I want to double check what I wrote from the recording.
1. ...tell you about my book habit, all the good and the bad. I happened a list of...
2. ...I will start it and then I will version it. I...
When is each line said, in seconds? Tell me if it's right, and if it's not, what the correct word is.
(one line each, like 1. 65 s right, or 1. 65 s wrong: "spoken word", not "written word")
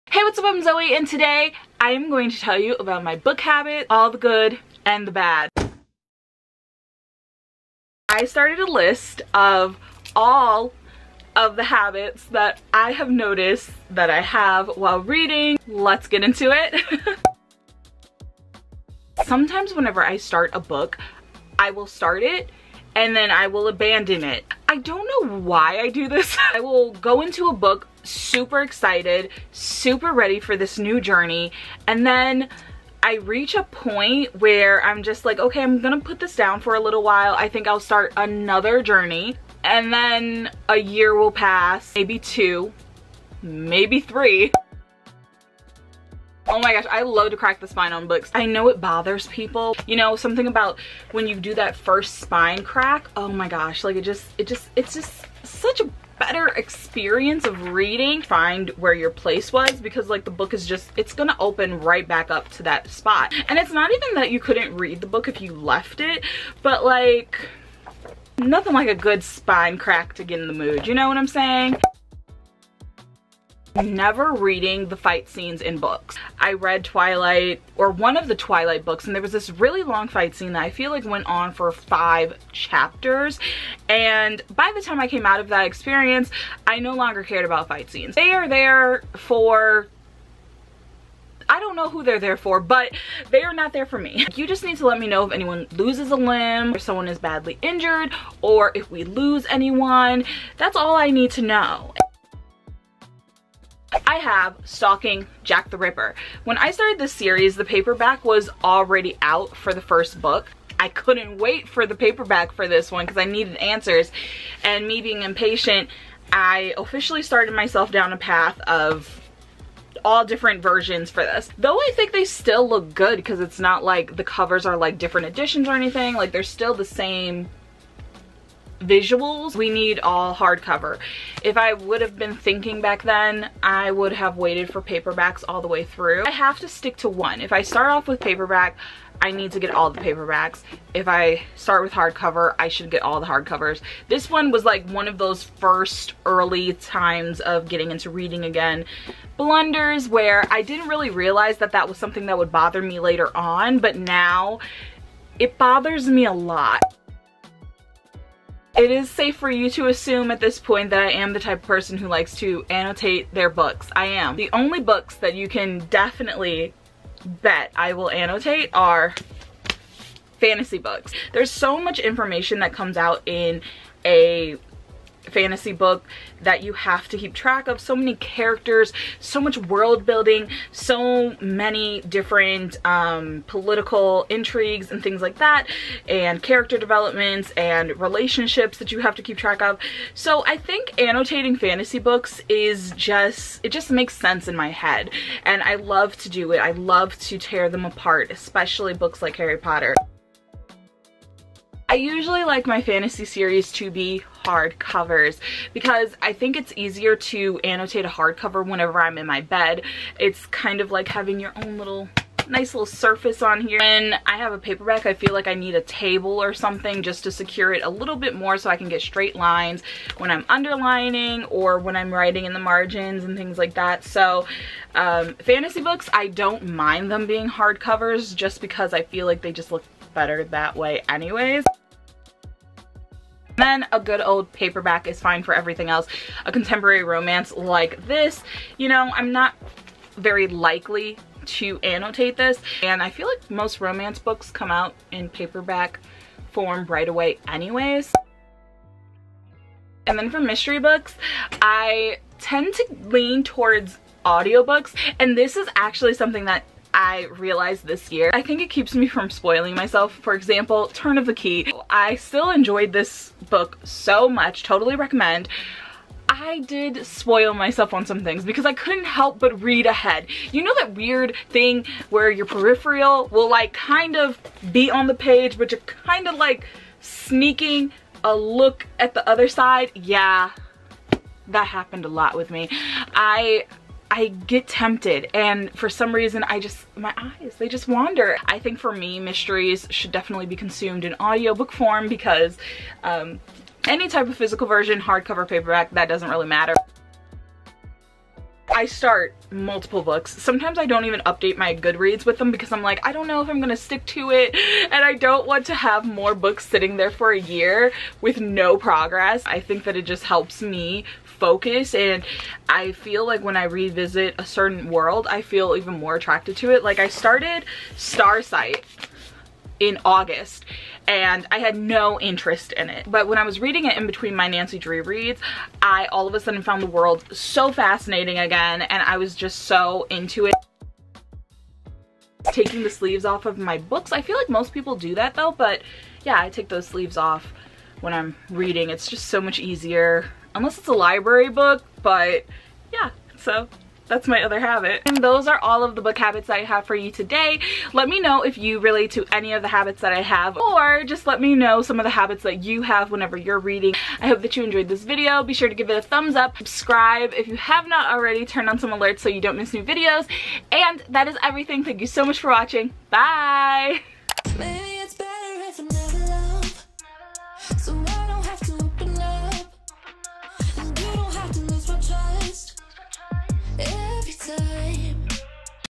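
1. 2 s wrong: "started", not "happened"
2. 21 s wrong: "abandon", not "version".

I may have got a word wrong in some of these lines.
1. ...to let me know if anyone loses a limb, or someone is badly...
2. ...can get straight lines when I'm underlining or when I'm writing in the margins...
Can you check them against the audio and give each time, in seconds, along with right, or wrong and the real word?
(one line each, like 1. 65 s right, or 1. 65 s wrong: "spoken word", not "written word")
1. 94 s right
2. 218 s right.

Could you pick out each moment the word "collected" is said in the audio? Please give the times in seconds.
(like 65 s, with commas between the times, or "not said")
not said.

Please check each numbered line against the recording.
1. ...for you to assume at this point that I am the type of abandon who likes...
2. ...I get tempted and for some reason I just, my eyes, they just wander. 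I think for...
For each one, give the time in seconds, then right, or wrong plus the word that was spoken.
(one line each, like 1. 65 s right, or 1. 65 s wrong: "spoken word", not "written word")
1. 159 s wrong: "person", not "abandon"
2. 284 s right.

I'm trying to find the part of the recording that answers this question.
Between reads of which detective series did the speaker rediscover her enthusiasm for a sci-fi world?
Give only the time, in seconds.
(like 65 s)
324 s.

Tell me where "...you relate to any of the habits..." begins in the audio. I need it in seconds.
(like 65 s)
348 s.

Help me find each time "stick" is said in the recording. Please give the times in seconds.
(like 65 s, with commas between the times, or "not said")
136 s, 303 s.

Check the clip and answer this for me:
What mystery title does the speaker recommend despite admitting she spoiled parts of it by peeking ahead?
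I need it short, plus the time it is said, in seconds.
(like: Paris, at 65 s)
Turn of the Key, at 260 s.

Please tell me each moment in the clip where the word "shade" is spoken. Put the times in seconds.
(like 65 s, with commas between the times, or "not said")
not said.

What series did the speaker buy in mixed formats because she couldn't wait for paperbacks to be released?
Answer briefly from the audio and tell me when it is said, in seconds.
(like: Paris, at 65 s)
Stalking Jack the Ripper, at 104 s.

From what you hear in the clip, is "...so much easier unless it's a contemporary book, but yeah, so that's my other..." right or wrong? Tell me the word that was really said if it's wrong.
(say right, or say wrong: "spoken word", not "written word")
wrong: "library", not "contemporary".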